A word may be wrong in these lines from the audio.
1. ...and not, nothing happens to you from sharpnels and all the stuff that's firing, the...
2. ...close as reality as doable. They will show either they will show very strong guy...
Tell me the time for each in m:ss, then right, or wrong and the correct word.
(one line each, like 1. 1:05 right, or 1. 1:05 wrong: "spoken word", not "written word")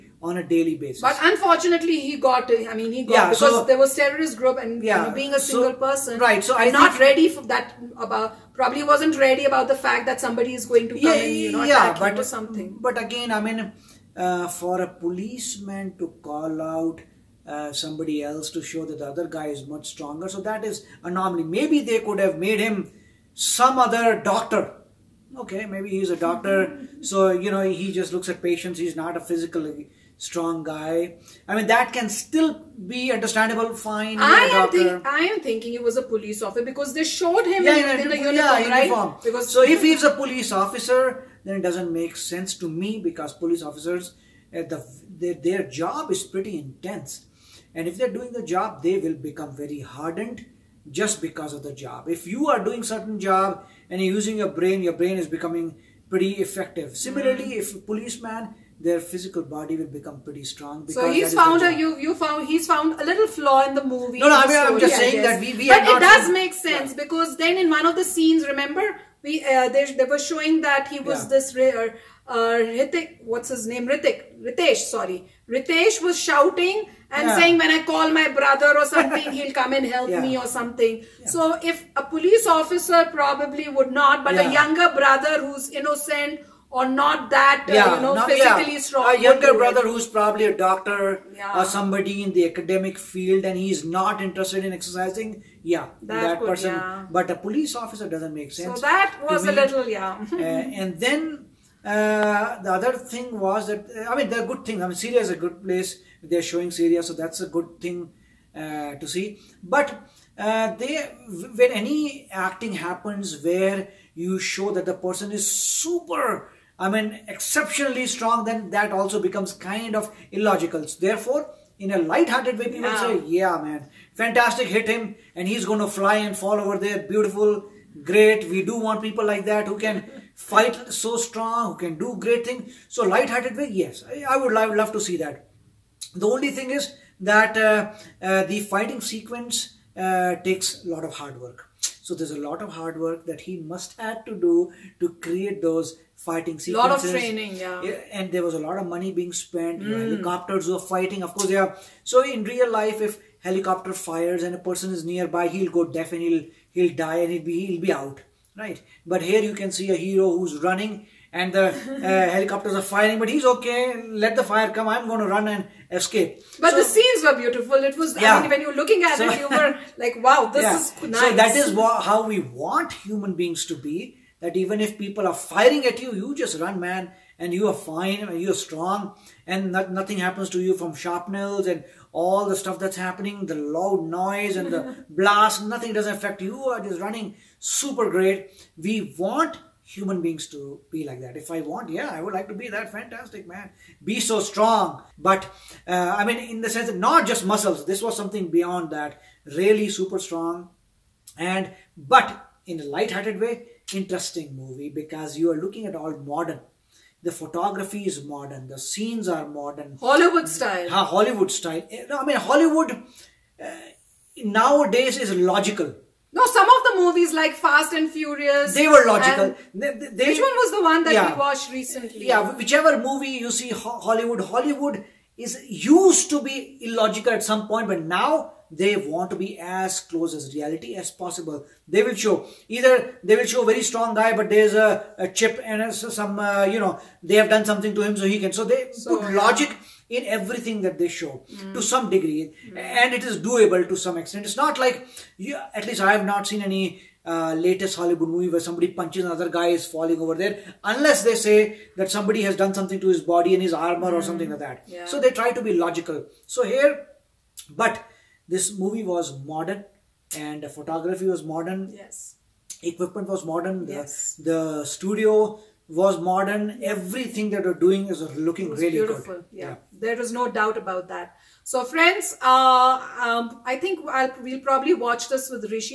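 1. 2:59 wrong: "happening", not "firing"
2. 3:49 wrong: "possible", not "doable".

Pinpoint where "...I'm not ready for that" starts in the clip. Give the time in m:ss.
0:06.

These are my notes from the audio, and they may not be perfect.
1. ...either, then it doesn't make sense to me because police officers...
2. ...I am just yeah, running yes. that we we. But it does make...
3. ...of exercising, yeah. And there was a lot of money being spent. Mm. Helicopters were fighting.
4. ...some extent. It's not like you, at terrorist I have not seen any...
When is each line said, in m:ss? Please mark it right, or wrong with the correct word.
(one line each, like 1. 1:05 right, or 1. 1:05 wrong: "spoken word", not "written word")
1. 0:40 wrong: "officer", not "either"
2. 1:04 wrong: "saying", not "running"
3. 2:27 wrong: "training", not "exercising"
4. 4:03 wrong: "least", not "terrorist".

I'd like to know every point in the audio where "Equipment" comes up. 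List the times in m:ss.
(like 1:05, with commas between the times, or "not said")
4:22.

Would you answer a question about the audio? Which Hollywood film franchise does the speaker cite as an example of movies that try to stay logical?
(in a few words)
Fast and Furious.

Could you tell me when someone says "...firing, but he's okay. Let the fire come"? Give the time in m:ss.
2:42.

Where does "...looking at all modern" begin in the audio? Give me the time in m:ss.
3:25.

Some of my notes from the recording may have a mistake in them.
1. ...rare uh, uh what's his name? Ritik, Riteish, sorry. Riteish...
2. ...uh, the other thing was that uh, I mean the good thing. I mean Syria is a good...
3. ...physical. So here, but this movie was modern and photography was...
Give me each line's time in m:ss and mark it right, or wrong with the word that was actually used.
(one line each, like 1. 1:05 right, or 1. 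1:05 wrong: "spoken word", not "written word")
1. 1:11 right
2. 1:41 right
3. 4:15 wrong: "logical", not "physical".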